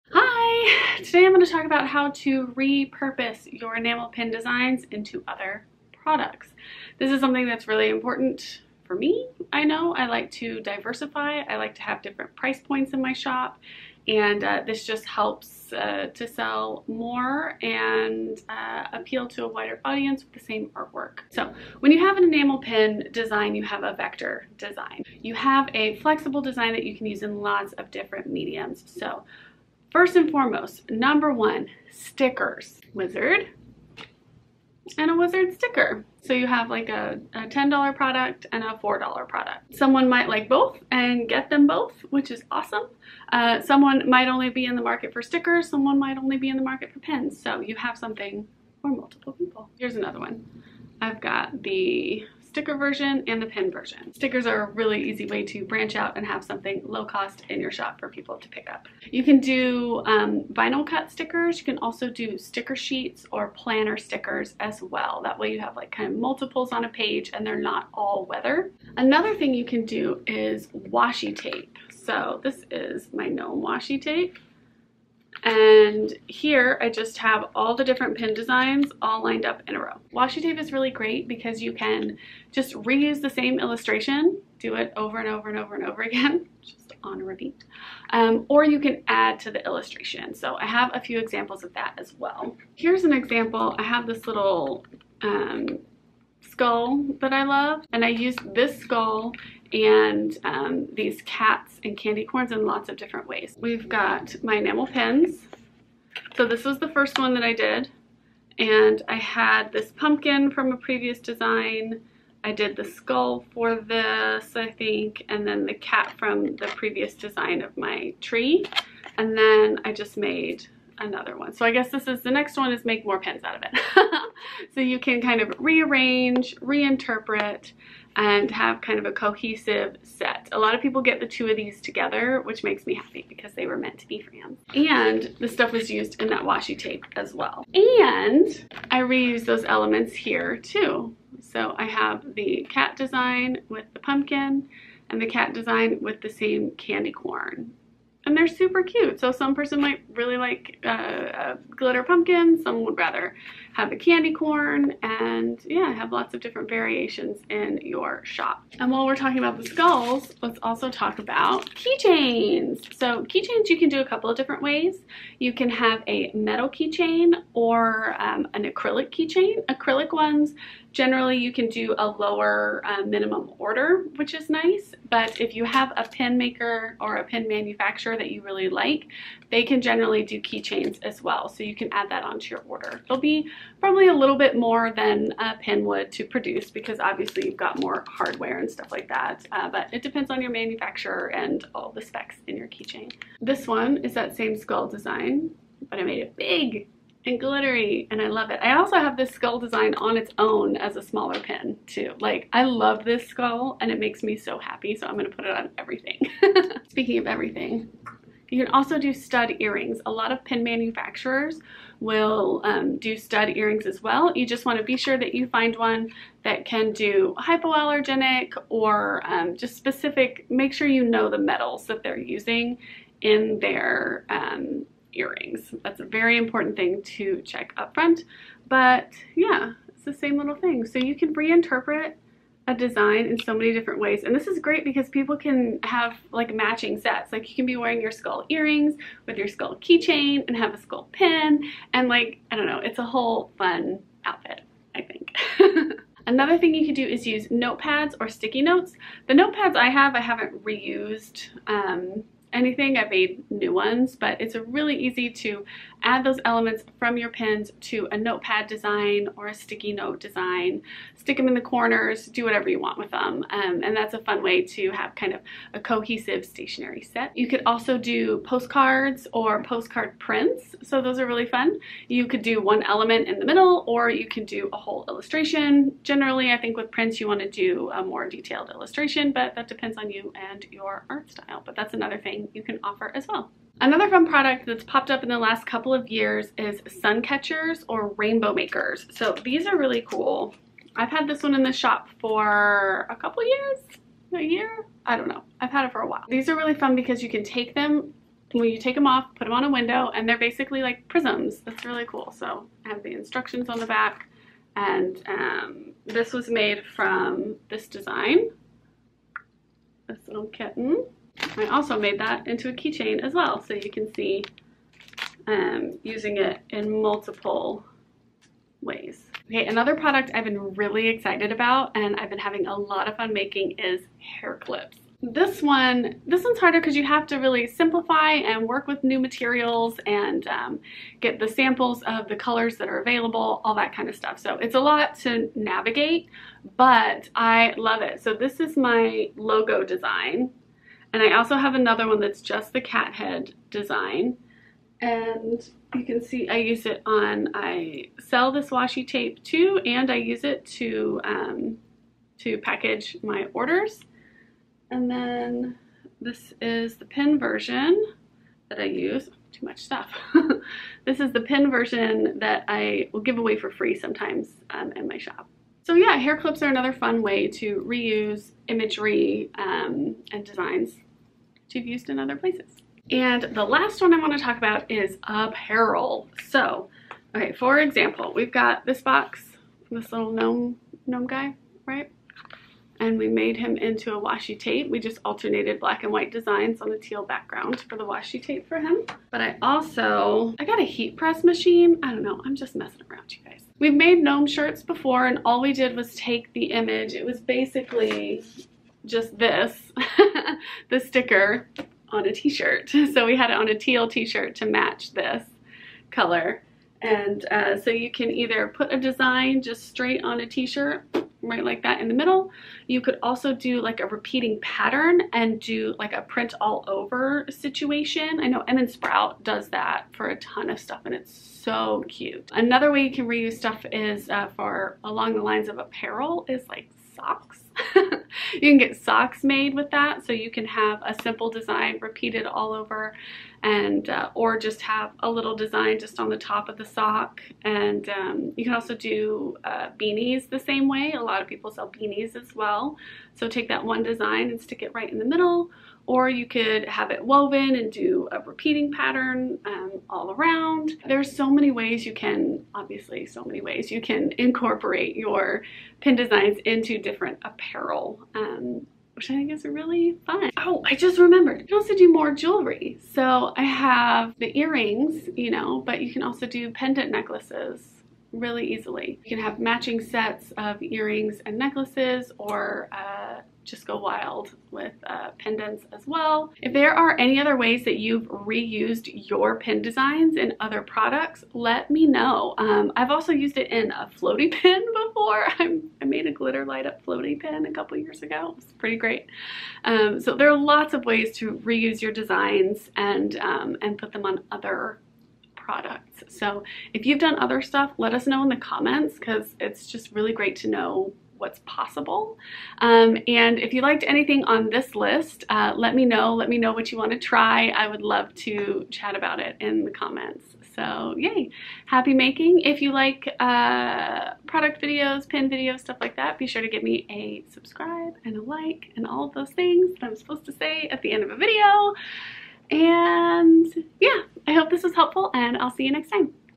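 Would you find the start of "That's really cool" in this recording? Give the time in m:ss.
5:01.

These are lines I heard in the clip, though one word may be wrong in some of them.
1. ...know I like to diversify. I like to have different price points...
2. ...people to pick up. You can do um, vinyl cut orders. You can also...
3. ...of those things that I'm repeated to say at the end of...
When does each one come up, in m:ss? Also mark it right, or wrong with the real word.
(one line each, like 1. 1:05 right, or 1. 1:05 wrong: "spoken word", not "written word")
1. 0:09 right
2. 0:58 wrong: "stickers", not "orders"
3. 8:39 wrong: "supposed", not "repeated".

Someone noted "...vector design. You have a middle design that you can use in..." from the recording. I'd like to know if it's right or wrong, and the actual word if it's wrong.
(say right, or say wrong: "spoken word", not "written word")
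wrong: "flexible", not "middle".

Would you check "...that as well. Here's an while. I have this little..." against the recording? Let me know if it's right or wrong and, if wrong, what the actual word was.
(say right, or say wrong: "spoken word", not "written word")
wrong: "example", not "while".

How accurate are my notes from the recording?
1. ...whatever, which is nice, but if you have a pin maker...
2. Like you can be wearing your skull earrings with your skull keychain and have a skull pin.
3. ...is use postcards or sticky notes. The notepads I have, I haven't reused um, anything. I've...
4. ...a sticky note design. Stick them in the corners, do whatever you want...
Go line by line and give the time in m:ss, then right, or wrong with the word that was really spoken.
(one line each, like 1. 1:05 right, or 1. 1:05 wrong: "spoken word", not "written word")
1. 2:53 wrong: "order", not "whatever"
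2. 3:57 right
3. 4:07 wrong: "notepads", not "postcards"
4. 4:19 right.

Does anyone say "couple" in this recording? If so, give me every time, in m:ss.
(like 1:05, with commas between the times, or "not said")
2:44, 4:45, 4:53, 8:07.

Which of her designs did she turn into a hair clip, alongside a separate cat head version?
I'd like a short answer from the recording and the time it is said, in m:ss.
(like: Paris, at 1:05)
logo, at 5:38.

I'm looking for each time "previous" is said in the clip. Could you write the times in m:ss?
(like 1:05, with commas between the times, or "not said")
1:50, 1:56.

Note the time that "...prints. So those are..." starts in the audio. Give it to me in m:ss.
4:30.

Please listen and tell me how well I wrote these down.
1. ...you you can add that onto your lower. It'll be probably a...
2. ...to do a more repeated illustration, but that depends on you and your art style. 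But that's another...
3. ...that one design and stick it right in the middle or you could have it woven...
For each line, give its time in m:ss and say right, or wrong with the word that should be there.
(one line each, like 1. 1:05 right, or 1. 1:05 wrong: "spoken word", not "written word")
1. 3:01 wrong: "order", not "lower"
2. 4:37 wrong: "detailed", not "repeated"
3. 7:23 right.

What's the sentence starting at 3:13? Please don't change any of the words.
This one is that same skull design, but I made it big and glittery and I love it.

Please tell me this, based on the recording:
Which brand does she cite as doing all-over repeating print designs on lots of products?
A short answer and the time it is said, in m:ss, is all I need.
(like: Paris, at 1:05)
Emin Sprout, at 6:58.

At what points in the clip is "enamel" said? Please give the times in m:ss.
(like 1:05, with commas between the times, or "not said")
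0:03, 0:22, 1:44.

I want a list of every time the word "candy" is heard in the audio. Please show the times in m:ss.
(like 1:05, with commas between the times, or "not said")
1:41, 2:26, 2:33.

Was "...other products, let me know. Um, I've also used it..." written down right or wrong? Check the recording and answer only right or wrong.
right.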